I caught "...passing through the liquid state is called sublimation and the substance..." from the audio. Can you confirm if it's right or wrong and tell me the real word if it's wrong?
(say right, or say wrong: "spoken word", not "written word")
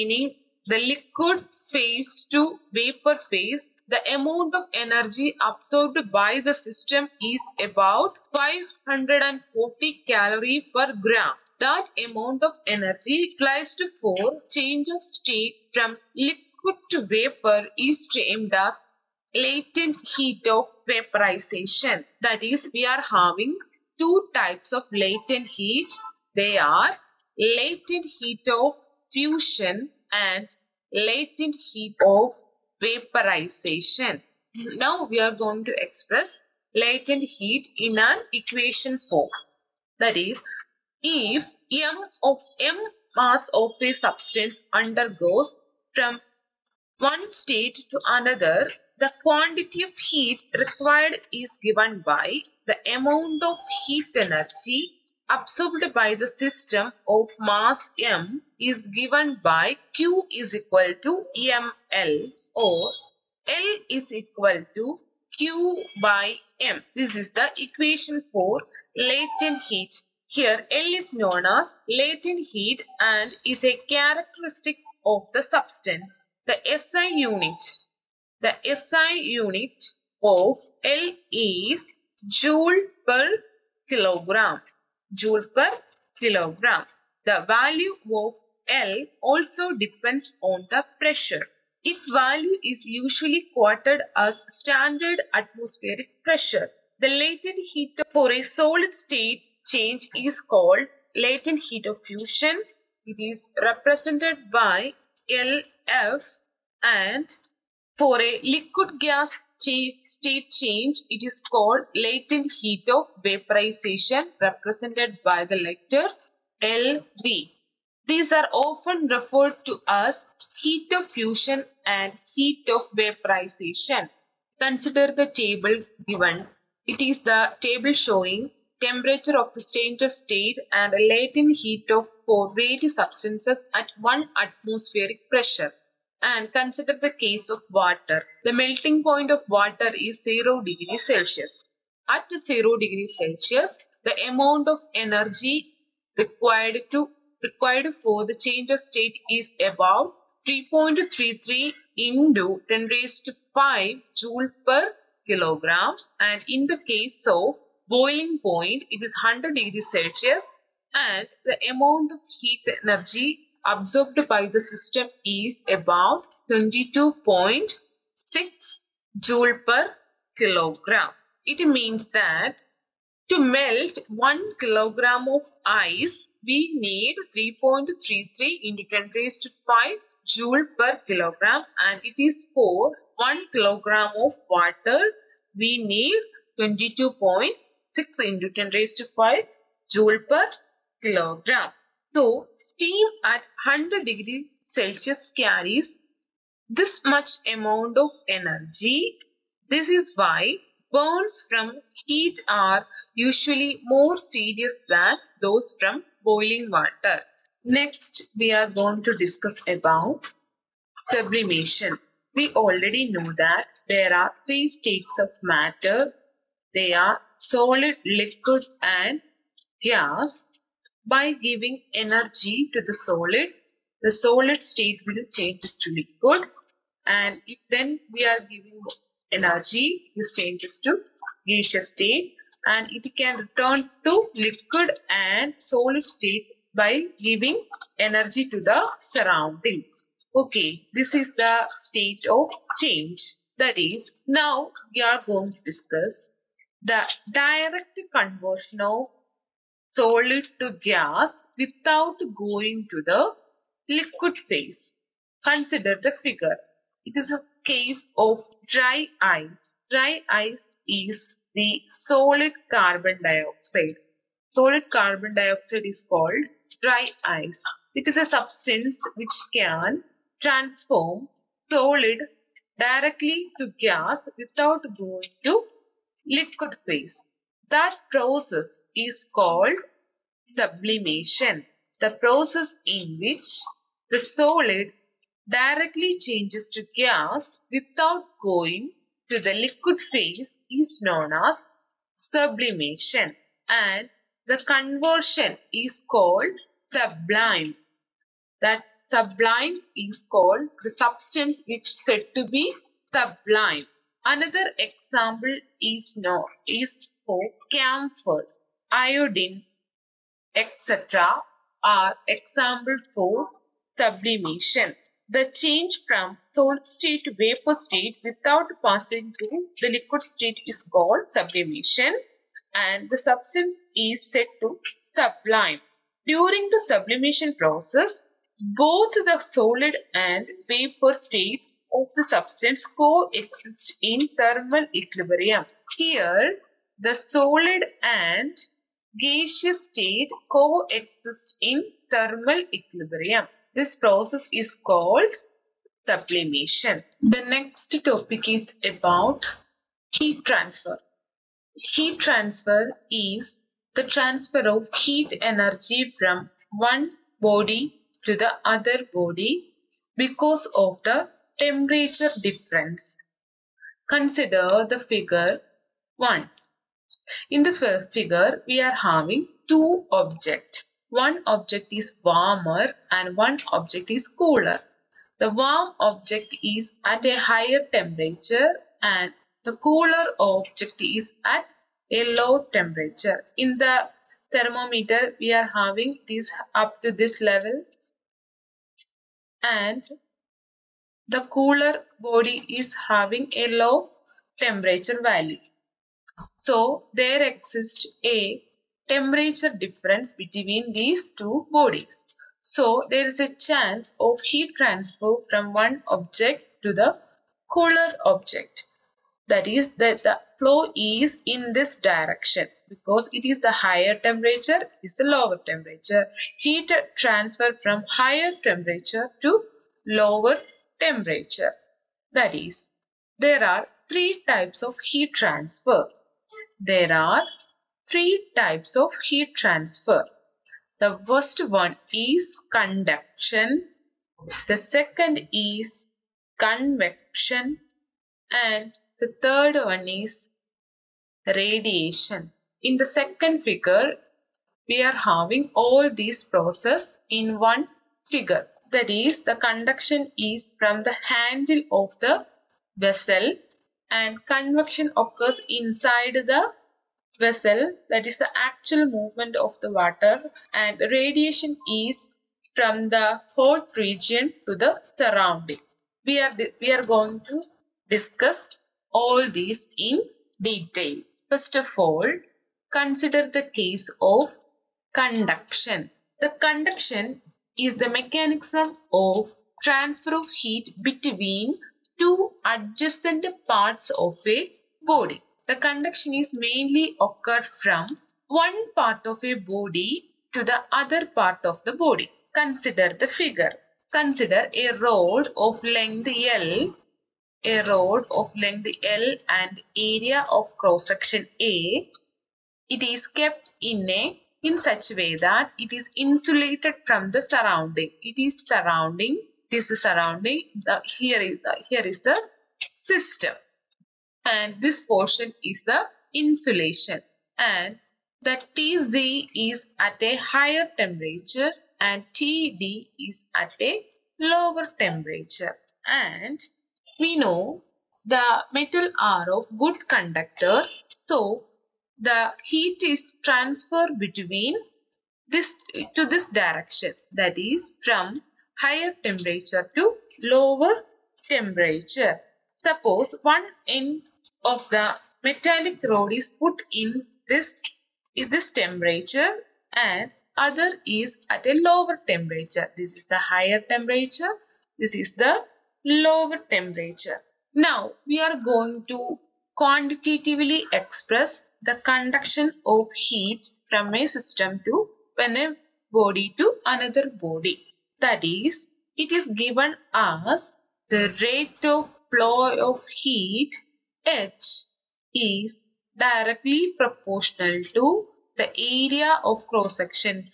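right.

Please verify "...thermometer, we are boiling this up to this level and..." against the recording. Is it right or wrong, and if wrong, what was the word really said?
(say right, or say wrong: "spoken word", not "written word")
wrong: "having", not "boiling".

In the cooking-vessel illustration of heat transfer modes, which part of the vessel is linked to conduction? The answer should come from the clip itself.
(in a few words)
the handle.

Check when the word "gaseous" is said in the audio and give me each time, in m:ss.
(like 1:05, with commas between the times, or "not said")
3:51, 5:39.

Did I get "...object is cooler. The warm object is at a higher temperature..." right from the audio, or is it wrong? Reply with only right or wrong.
right.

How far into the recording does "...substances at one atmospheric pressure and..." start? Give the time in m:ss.
2:12.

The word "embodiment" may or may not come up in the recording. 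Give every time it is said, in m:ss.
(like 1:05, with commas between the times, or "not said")
not said.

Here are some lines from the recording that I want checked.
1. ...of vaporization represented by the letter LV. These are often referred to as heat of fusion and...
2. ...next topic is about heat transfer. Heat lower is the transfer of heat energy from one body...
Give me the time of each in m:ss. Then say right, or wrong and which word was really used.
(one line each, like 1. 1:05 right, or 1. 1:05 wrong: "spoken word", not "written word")
1. 1:52 right
2. 5:47 wrong: "transfer", not "lower".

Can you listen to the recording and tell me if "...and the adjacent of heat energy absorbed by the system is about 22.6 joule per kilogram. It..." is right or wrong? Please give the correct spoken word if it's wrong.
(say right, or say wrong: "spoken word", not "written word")
wrong: "amount", not "adjacent".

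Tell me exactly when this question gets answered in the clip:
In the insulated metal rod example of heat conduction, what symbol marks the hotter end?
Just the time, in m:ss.
8:38.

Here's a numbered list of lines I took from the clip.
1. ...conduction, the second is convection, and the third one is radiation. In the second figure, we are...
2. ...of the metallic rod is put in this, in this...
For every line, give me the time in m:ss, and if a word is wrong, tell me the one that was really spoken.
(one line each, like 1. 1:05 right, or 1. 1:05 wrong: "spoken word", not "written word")
1. 7:12 right
2. 9:04 right.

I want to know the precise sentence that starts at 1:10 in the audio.
Here L is known as latent heat and is a characteristic of the substance.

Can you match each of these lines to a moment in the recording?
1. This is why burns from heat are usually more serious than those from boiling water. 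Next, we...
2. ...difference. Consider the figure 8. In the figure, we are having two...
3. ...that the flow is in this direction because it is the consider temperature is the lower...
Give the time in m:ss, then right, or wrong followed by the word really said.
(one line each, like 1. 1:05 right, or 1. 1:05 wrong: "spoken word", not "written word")
1. 3:19 right
2. 6:02 wrong: "1", not "8"
3. 6:49 wrong: "higher", not "consider".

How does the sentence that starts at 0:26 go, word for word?
They are latent heat of fusion and latent heat of vaporization.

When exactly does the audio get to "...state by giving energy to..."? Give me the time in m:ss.
3:56.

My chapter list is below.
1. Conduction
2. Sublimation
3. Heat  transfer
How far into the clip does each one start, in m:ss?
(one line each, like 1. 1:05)
1. 7:52
2. 3:27
3. 5:48.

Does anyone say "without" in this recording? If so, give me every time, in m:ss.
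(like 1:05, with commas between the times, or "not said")
4:11, 4:34, 4:47, 5:18.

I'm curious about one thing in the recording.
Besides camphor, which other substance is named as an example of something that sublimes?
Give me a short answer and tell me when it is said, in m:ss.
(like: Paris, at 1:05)
iodine, at 5:08.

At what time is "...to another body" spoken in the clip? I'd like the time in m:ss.
9:26.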